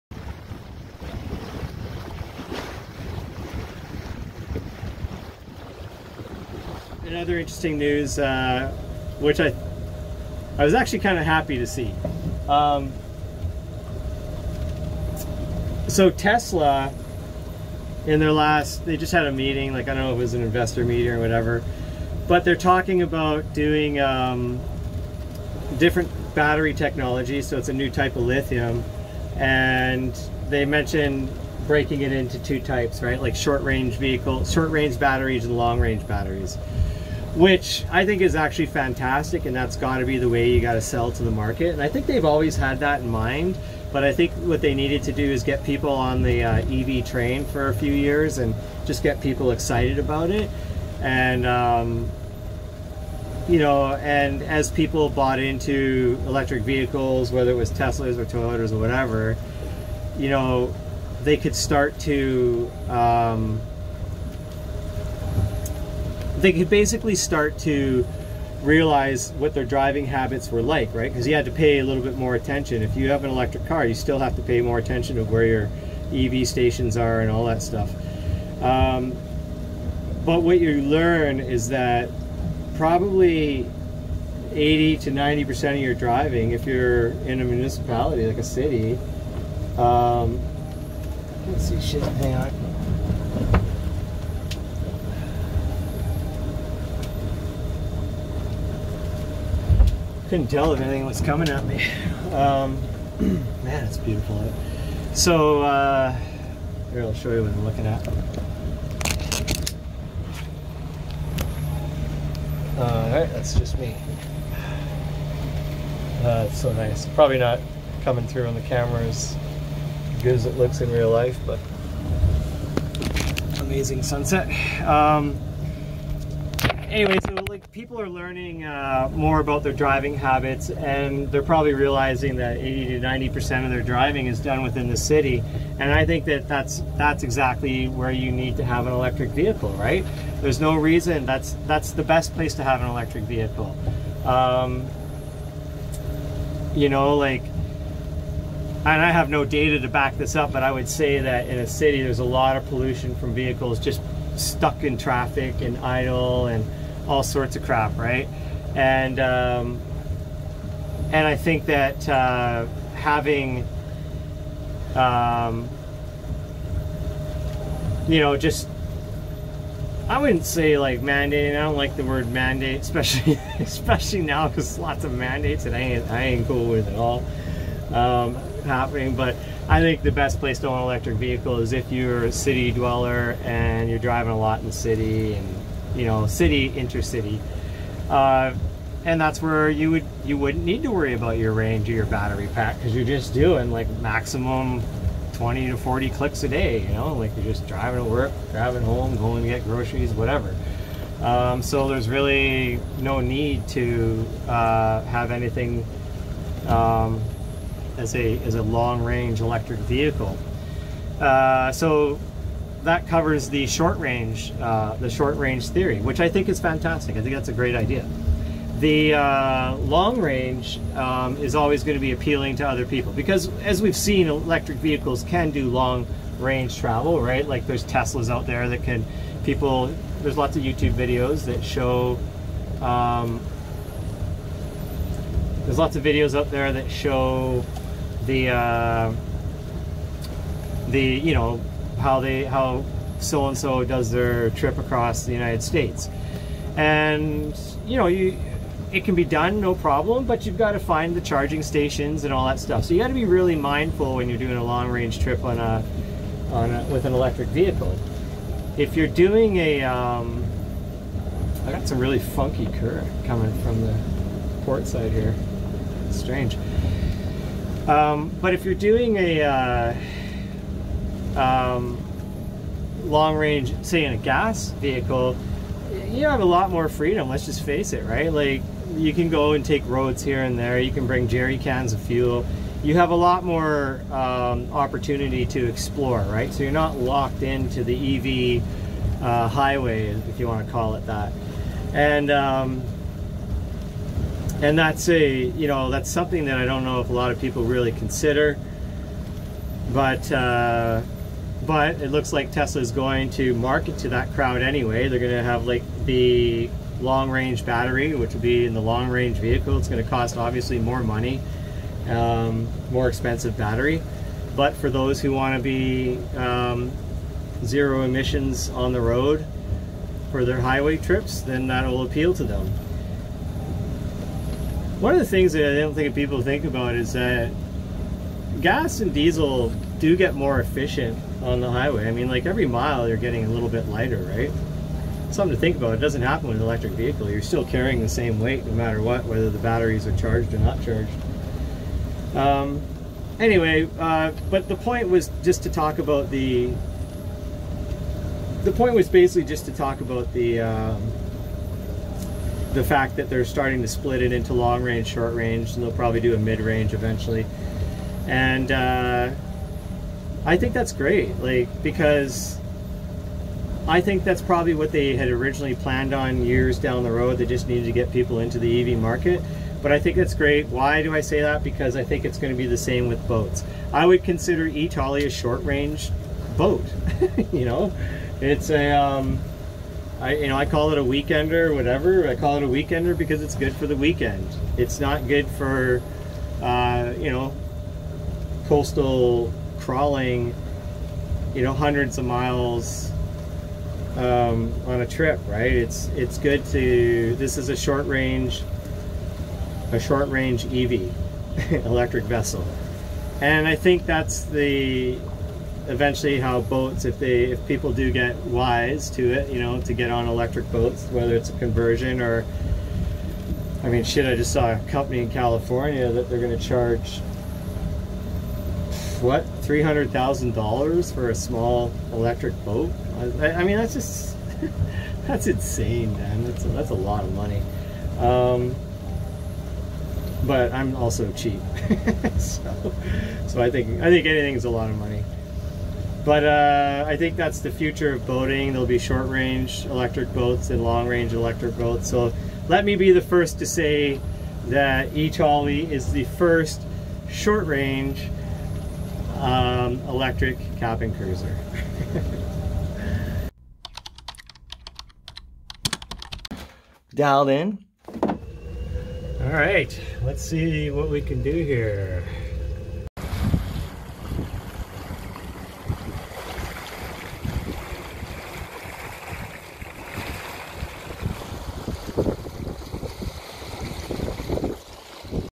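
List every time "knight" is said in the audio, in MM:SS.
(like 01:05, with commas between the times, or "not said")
not said.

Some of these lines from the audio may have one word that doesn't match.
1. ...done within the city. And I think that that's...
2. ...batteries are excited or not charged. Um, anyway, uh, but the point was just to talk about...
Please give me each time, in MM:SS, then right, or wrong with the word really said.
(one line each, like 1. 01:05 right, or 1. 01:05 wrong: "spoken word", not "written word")
1. 02:14 right
2. 05:39 wrong: "charged", not "excited".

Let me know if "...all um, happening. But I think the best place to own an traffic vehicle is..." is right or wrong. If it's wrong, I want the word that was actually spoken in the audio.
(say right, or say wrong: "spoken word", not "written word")
wrong: "electric", not "traffic".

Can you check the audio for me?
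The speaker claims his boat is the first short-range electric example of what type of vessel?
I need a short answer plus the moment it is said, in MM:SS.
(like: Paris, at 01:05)
cabin cruiser, at 07:30.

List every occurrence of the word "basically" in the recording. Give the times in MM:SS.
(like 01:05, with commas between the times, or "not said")
01:06, 05:49.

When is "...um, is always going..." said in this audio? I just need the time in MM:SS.
03:40.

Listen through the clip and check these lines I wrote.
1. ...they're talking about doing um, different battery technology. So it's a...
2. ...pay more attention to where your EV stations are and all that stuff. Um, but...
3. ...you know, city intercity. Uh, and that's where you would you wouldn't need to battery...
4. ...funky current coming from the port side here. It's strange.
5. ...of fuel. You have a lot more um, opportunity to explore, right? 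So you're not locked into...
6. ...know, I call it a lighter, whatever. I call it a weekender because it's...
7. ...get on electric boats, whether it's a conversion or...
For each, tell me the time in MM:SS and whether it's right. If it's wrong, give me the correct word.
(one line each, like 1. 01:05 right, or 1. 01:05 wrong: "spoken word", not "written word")
1. 00:22 right
2. 01:14 right
3. 03:05 wrong: "worry", not "battery"
4. 04:22 right
5. 04:41 right
6. 06:20 wrong: "weekender", not "lighter"
7. 06:49 right.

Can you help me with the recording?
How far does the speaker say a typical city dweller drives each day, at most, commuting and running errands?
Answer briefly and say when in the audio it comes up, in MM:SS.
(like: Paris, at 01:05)
20 to 40 clicks, at 03:15.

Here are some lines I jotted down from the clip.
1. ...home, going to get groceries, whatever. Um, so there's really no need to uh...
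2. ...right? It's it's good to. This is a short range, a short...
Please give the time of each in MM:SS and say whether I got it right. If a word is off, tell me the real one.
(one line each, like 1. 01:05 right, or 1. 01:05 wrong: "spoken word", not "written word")
1. 03:18 right
2. 06:35 right.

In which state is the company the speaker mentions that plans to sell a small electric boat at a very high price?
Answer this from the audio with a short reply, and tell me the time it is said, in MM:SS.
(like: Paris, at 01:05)
California, at 06:55.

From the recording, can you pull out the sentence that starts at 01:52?
all uh, right, that's just me.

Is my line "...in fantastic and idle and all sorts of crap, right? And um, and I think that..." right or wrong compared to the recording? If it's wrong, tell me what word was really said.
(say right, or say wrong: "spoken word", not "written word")
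wrong: "traffic", not "fantastic".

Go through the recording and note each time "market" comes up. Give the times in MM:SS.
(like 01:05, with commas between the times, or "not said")
00:41, 05:03, 06:08.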